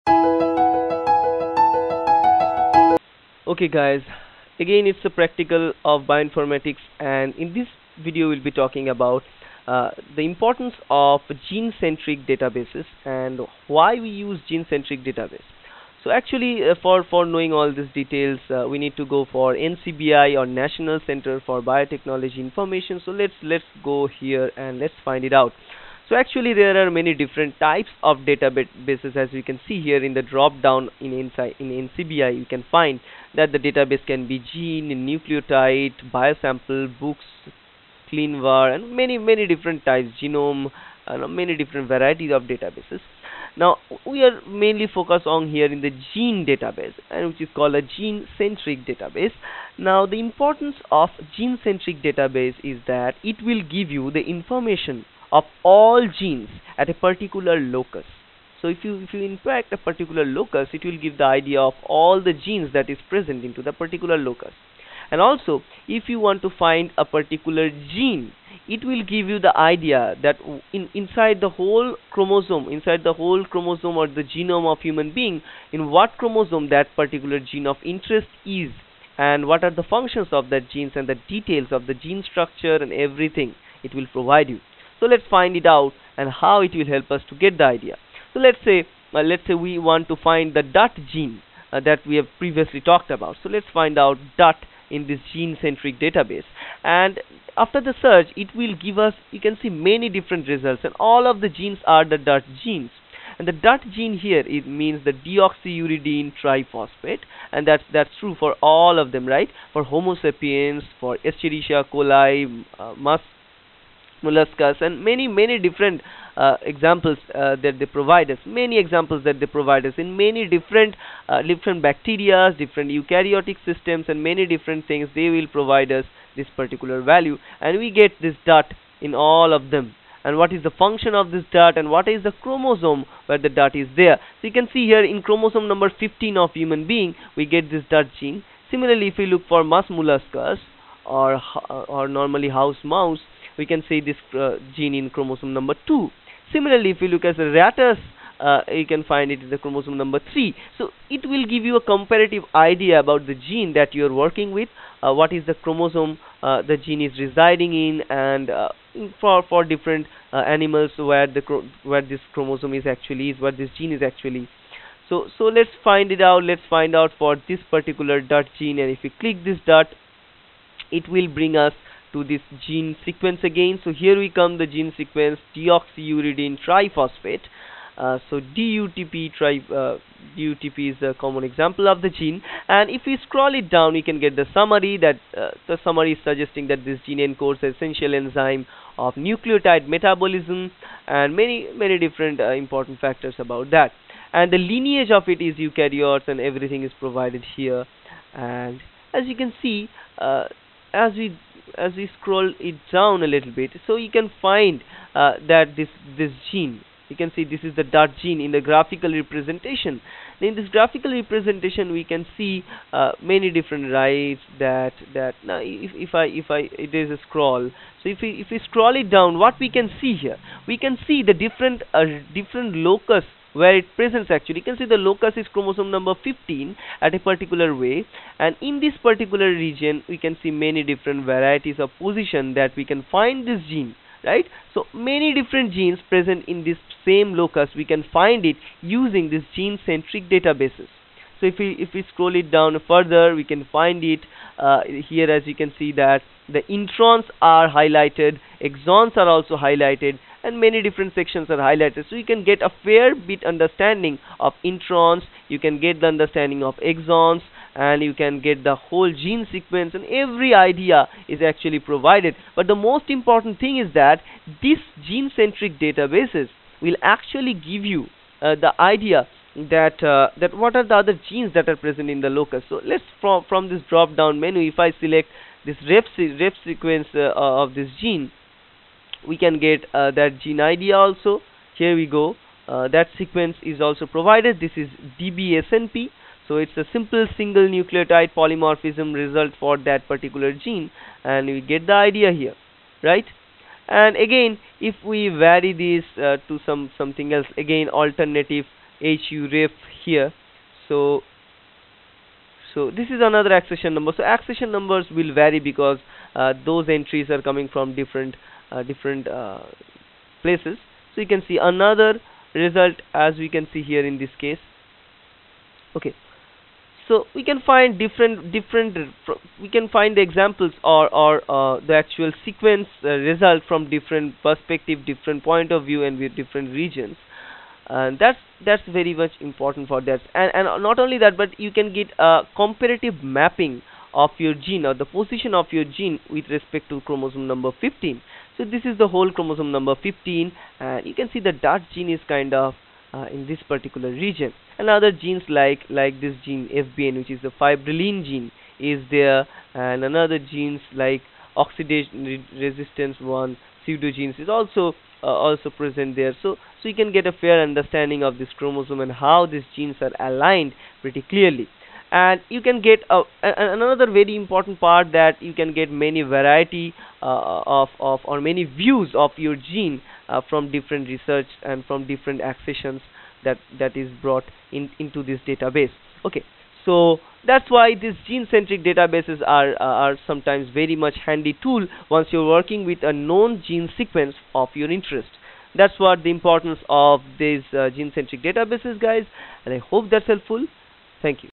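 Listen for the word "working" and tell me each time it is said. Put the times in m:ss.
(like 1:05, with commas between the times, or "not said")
2:34, 6:22.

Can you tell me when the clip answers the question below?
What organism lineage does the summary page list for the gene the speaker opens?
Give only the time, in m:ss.
3:15.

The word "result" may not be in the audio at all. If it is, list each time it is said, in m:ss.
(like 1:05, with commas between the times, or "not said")
1:40, 4:49, 5:12, 5:23.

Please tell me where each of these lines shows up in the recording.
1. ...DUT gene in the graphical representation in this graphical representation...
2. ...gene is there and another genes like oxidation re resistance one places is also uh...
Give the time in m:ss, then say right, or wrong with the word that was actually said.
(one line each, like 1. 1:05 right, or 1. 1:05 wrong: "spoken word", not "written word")
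1. 3:27 right
2. 5:48 wrong: "pseudogenes", not "places".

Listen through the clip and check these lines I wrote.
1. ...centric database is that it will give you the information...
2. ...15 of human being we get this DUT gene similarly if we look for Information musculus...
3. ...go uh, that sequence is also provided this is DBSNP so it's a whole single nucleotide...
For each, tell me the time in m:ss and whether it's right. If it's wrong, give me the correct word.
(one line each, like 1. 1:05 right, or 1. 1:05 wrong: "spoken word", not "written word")
1. 0:51 right
2. 2:15 wrong: "Mus", not "Information"
3. 4:42 wrong: "simple", not "whole".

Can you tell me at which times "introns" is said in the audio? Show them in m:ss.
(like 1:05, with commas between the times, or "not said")
4:06, 4:14.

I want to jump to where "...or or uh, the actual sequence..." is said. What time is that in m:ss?
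5:20.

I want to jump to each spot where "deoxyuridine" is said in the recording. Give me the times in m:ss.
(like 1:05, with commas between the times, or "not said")
1:45, 2:55.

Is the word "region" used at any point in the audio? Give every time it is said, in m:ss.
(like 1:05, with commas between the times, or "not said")
3:49, 5:26, 5:44.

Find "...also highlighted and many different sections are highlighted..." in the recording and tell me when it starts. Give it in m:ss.
4:09.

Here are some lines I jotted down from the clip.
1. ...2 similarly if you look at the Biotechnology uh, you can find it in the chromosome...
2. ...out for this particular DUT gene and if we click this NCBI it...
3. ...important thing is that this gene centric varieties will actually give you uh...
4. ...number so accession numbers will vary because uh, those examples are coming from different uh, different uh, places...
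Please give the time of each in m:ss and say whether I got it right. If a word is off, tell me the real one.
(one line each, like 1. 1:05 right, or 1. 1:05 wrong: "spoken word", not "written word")
1. 2:25 wrong: "Rattus", not "Biotechnology"
2. 2:47 wrong: "DUT", not "NCBI"
3. 4:23 wrong: "databases", not "varieties"
4. 5:03 wrong: "entries", not "examples".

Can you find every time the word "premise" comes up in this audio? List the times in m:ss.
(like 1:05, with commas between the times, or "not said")
not said.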